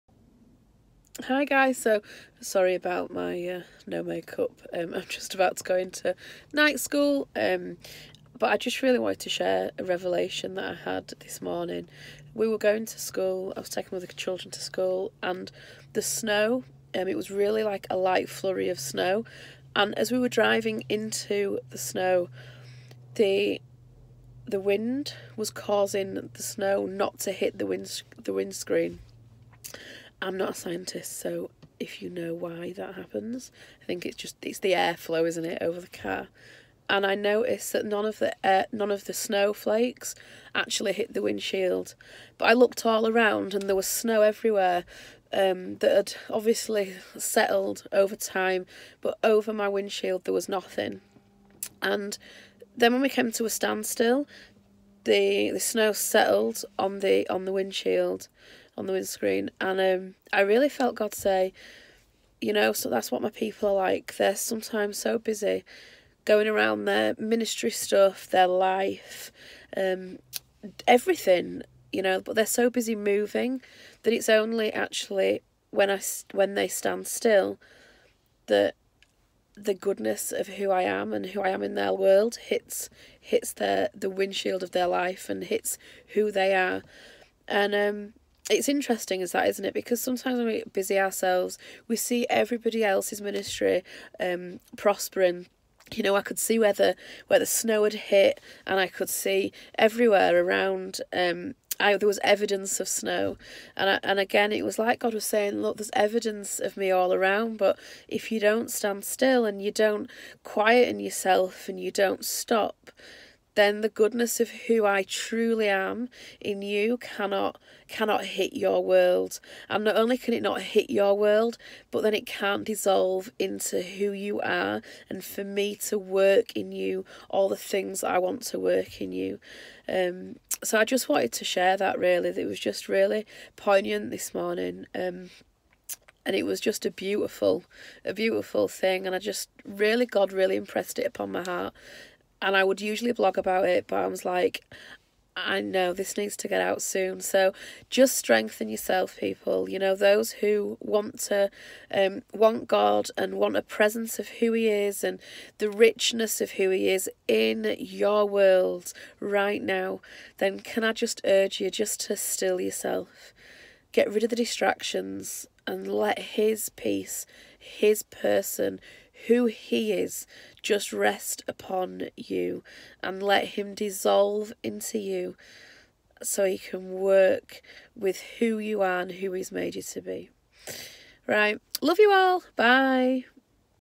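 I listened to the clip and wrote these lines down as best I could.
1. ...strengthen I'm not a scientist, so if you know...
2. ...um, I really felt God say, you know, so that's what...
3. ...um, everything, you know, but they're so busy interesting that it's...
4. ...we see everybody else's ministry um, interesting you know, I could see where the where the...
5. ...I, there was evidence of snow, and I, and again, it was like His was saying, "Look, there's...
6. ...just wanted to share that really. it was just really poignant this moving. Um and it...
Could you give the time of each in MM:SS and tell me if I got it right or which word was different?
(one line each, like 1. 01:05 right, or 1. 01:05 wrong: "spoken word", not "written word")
1. 00:28 wrong: "windscreen", not "strengthen"
2. 00:59 right
3. 01:09 wrong: "moving", not "interesting"
4. 01:31 wrong: "prospering", not "interesting"
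5. 01:41 wrong: "God", not "His"
6. 02:10 wrong: "morning", not "moving".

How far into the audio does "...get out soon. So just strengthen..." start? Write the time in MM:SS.
02:26.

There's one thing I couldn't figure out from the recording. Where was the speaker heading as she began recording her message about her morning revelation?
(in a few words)
night school.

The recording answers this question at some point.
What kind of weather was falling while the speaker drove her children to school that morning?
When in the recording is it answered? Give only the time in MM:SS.
00:17.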